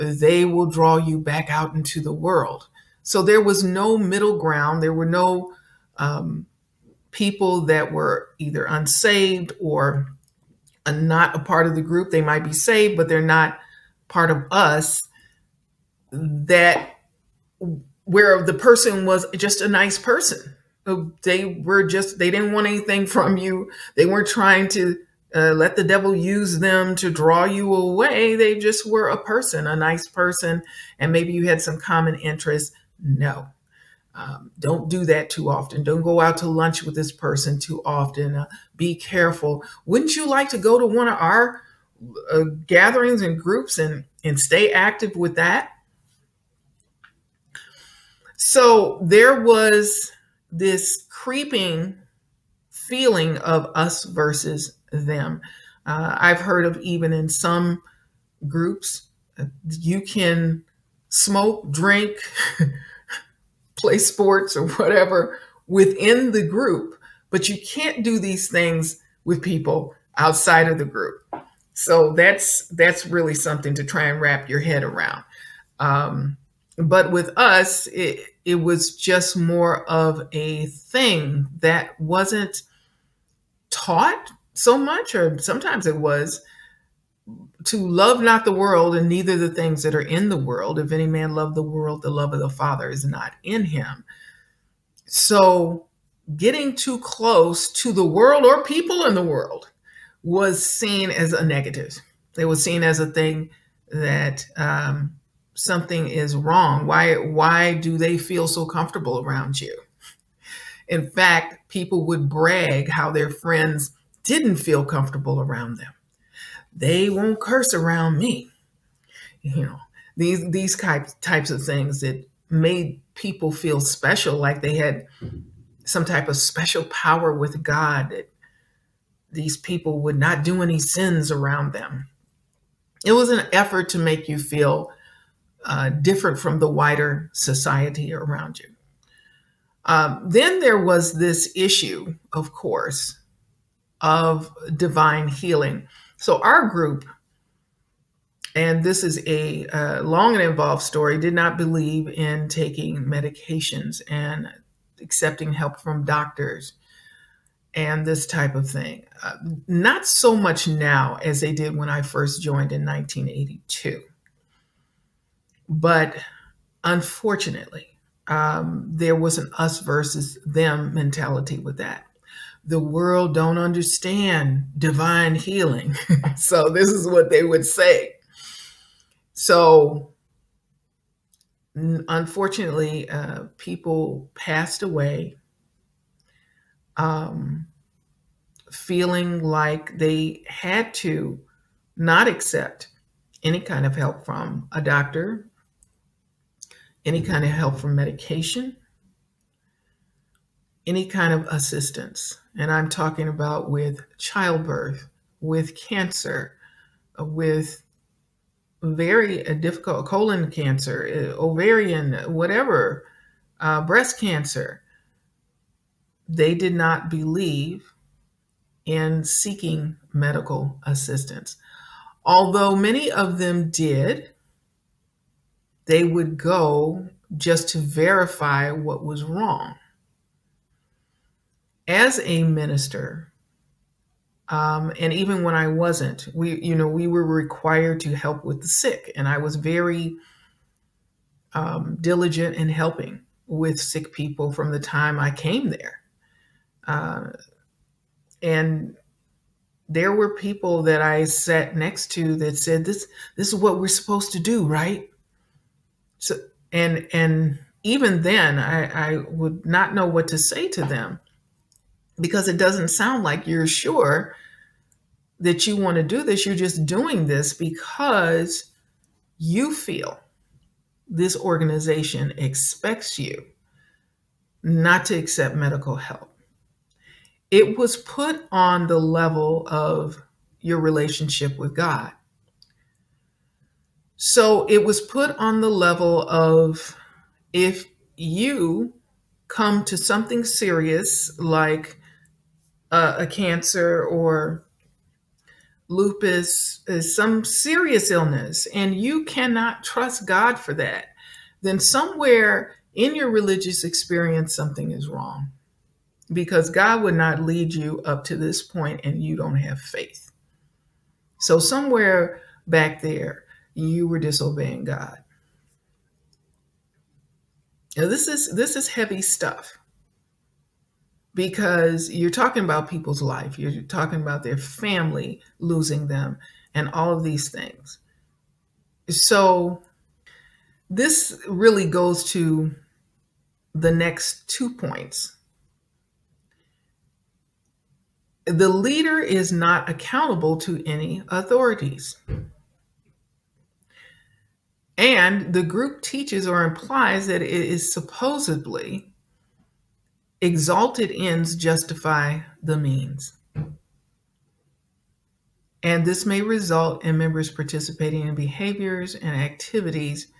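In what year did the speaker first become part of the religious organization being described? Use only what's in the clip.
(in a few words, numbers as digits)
1982.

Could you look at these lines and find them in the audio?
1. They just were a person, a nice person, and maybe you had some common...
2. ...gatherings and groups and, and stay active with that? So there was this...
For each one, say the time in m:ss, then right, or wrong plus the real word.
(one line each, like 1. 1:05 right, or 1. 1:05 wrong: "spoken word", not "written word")
1. 0:28 right
2. 0:42 right.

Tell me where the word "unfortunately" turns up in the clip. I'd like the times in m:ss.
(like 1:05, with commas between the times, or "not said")
2:46, 3:01.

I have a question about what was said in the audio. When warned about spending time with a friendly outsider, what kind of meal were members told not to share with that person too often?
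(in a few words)
lunch.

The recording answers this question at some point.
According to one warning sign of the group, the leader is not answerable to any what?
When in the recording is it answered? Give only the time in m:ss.
5:41.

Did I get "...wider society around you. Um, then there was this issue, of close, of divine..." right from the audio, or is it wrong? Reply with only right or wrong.
wrong.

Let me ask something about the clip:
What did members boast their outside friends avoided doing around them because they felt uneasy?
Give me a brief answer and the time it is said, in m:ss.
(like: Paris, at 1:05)
curse, at 1:57.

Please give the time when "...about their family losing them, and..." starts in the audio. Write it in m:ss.
5:24.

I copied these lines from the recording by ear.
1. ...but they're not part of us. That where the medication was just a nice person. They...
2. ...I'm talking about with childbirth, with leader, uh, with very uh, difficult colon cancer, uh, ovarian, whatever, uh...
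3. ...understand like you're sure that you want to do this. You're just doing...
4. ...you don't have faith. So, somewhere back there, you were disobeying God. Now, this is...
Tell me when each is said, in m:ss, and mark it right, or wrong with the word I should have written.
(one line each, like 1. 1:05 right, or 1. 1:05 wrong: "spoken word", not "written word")
1. 0:12 wrong: "person", not "medication"
2. 3:22 wrong: "cancer", not "leader"
3. 4:22 wrong: "sound", not "understand"
4. 5:09 right.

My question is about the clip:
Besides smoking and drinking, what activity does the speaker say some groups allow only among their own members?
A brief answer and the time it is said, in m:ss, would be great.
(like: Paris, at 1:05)
play sports, at 1:03.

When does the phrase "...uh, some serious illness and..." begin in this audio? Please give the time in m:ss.
4:56.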